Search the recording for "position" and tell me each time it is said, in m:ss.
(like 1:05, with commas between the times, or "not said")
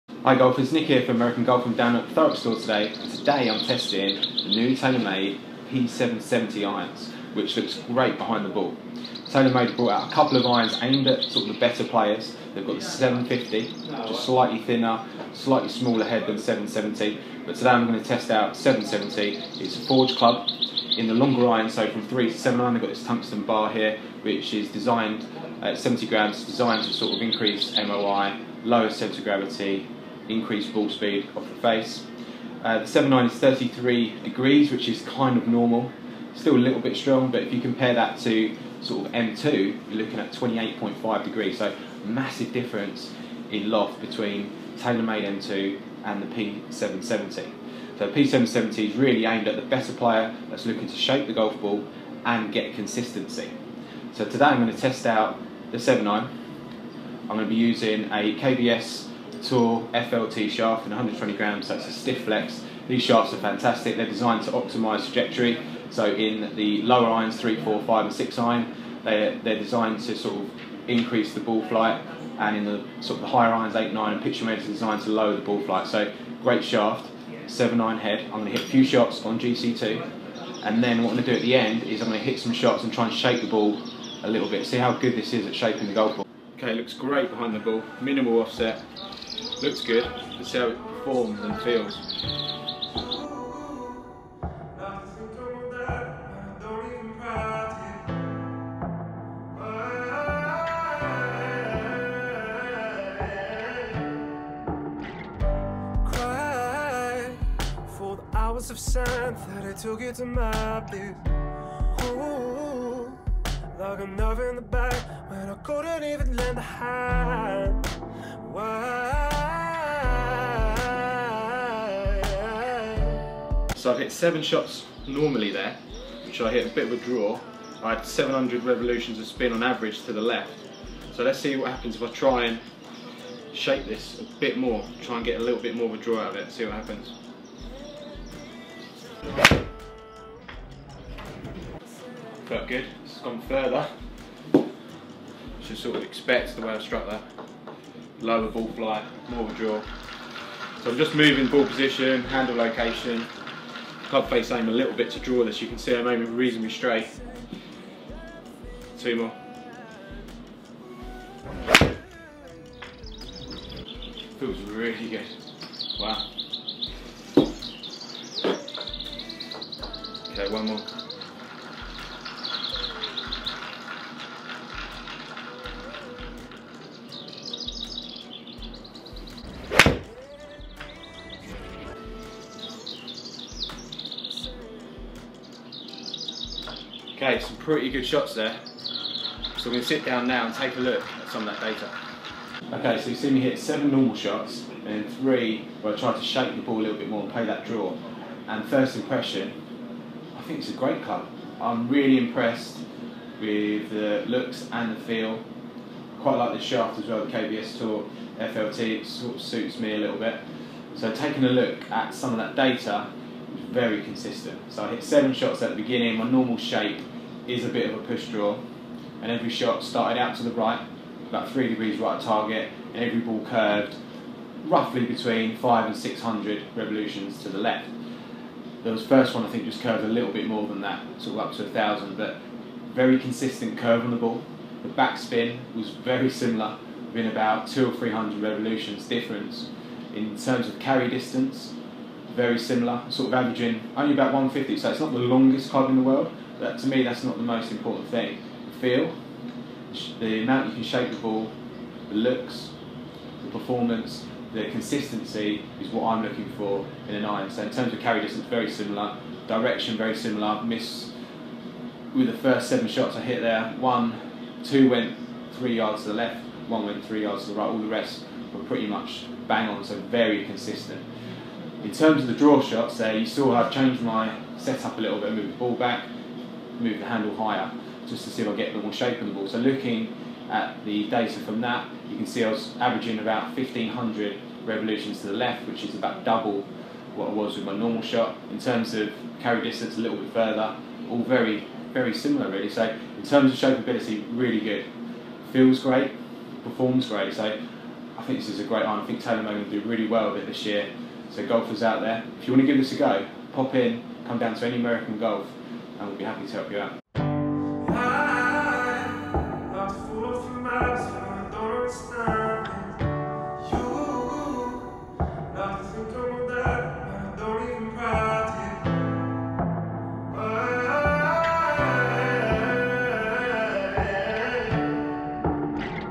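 2:31.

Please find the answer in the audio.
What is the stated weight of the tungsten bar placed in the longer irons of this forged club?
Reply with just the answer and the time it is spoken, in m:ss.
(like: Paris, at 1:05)
70 grams, at 0:25.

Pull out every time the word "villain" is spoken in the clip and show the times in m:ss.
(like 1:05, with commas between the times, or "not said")
not said.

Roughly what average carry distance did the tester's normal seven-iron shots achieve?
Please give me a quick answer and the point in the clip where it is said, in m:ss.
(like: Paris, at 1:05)
150, at 4:04.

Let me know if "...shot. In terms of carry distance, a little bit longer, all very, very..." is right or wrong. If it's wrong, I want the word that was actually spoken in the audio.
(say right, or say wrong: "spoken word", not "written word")
wrong: "further", not "longer".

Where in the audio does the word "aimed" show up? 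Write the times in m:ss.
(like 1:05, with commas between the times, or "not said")
0:10, 0:49.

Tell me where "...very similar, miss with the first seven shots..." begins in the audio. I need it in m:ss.
4:19.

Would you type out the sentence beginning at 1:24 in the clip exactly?
See how good this is at shaping the golf ball.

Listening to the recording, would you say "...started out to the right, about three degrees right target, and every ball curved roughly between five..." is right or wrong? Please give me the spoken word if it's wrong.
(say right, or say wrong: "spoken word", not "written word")
right.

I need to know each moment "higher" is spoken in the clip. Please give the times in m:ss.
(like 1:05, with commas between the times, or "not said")
1:13, 4:37.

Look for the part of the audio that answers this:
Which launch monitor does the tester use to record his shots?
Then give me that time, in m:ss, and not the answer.
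1:19.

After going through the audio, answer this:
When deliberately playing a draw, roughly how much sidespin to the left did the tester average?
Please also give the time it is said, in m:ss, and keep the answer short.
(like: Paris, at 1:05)
1500 revolutions, at 4:43.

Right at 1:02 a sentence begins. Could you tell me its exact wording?
These shafts are fantastic, they're designed to optimise trajectory.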